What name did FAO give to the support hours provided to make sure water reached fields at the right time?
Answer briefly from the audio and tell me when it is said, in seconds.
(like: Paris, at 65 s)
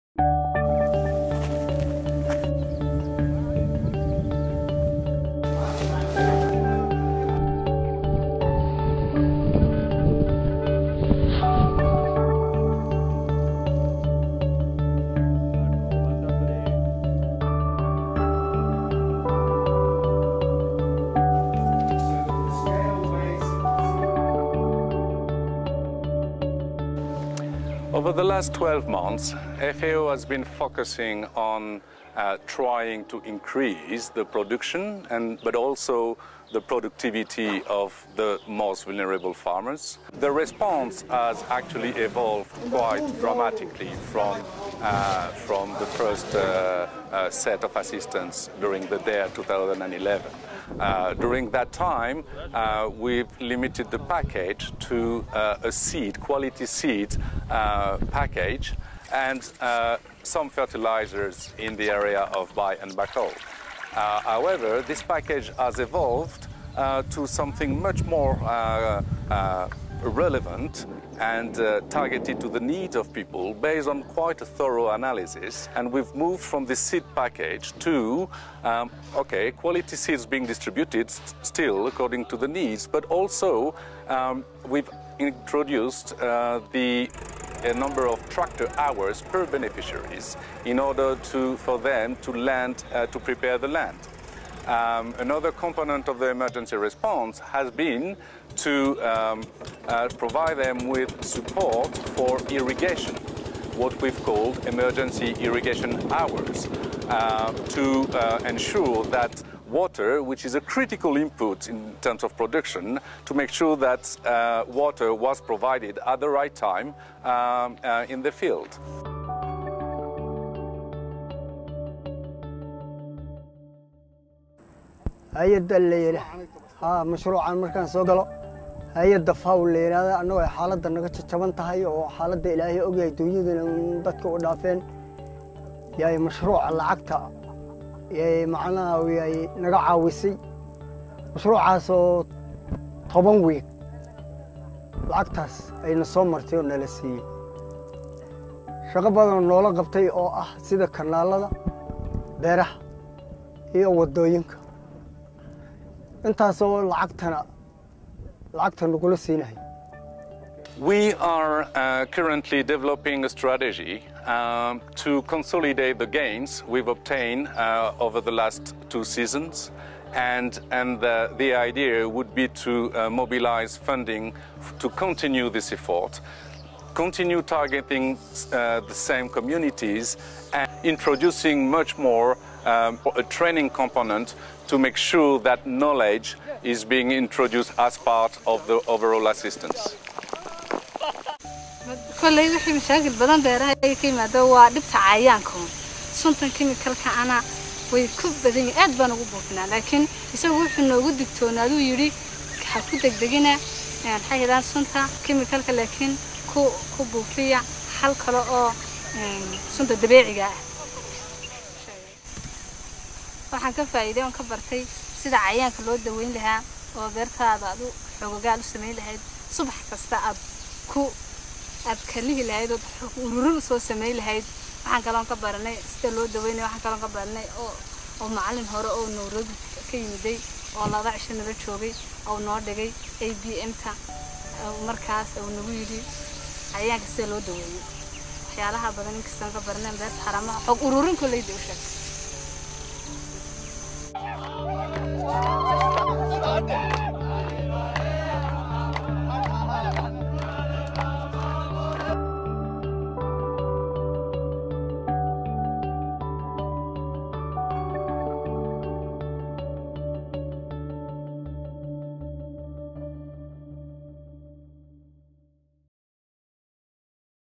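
Emergency irrigation hours, at 104 s.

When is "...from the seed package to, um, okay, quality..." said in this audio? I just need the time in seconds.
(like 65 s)
76 s.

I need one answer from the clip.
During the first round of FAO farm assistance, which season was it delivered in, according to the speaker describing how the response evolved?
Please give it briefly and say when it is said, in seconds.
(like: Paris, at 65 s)
Deyr 2011, at 48 s.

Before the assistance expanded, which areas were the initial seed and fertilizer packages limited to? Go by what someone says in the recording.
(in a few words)
Bay and Bakool.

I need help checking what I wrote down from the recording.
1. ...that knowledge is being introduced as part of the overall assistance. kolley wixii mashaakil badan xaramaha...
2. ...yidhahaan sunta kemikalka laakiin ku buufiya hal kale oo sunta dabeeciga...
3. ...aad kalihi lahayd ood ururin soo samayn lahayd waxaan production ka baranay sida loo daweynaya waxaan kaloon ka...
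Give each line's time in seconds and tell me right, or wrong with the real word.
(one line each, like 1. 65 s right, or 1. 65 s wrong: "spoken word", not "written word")
1. 185 s wrong: "beeraha", not "xaramaha"
2. 204 s right
3. 221 s wrong: "kaloon", not "production".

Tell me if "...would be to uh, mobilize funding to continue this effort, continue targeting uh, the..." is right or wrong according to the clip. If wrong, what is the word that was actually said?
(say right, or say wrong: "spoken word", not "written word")
right.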